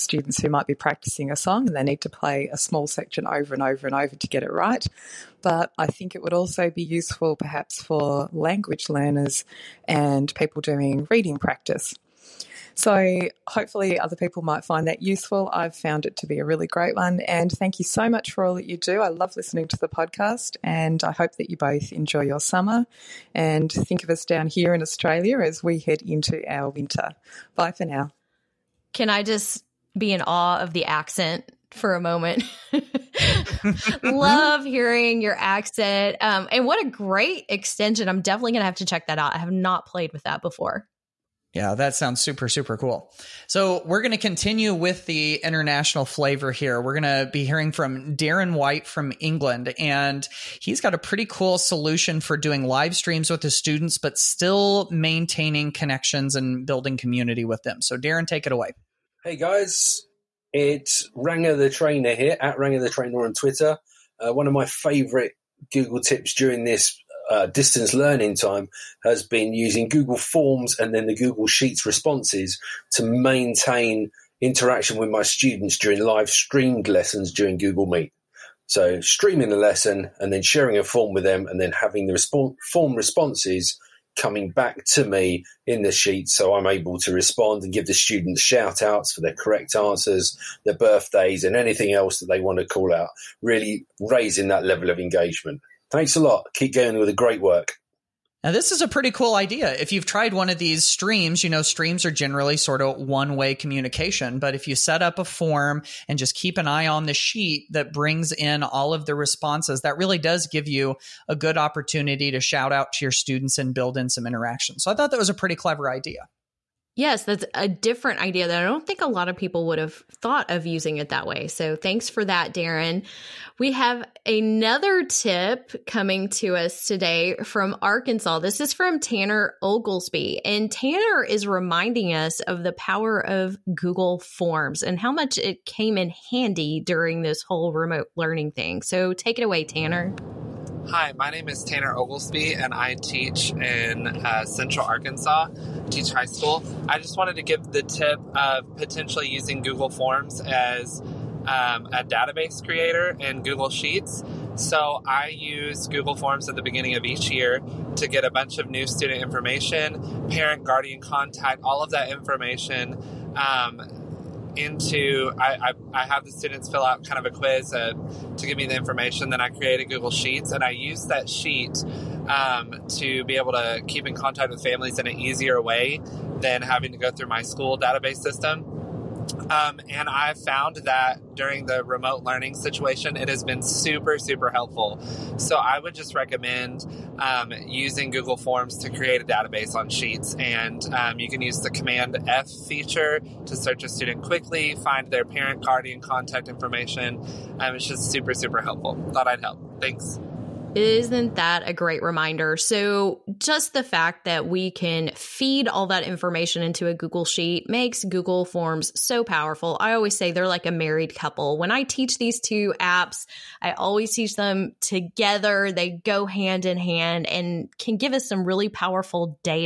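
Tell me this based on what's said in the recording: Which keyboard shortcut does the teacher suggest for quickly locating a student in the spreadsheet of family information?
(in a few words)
Command F.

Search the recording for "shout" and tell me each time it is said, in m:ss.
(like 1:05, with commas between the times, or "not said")
1:28, 1:52.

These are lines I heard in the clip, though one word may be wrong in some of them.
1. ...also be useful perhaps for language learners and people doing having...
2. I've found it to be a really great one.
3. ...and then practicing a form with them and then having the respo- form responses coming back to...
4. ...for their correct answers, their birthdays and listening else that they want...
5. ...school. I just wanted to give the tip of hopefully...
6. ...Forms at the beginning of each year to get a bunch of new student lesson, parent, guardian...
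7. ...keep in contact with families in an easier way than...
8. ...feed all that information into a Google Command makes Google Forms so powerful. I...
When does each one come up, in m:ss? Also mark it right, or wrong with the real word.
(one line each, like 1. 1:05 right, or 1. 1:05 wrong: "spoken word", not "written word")
1. 0:06 wrong: "reading", not "having"
2. 0:15 right
3. 1:20 wrong: "sharing", not "practicing"
4. 1:29 wrong: "anything", not "listening"
5. 2:26 wrong: "potentially", not "hopefully"
6. 2:36 wrong: "information", not "lesson"
7. 2:53 right
8. 3:25 wrong: "Sheet", not "Command".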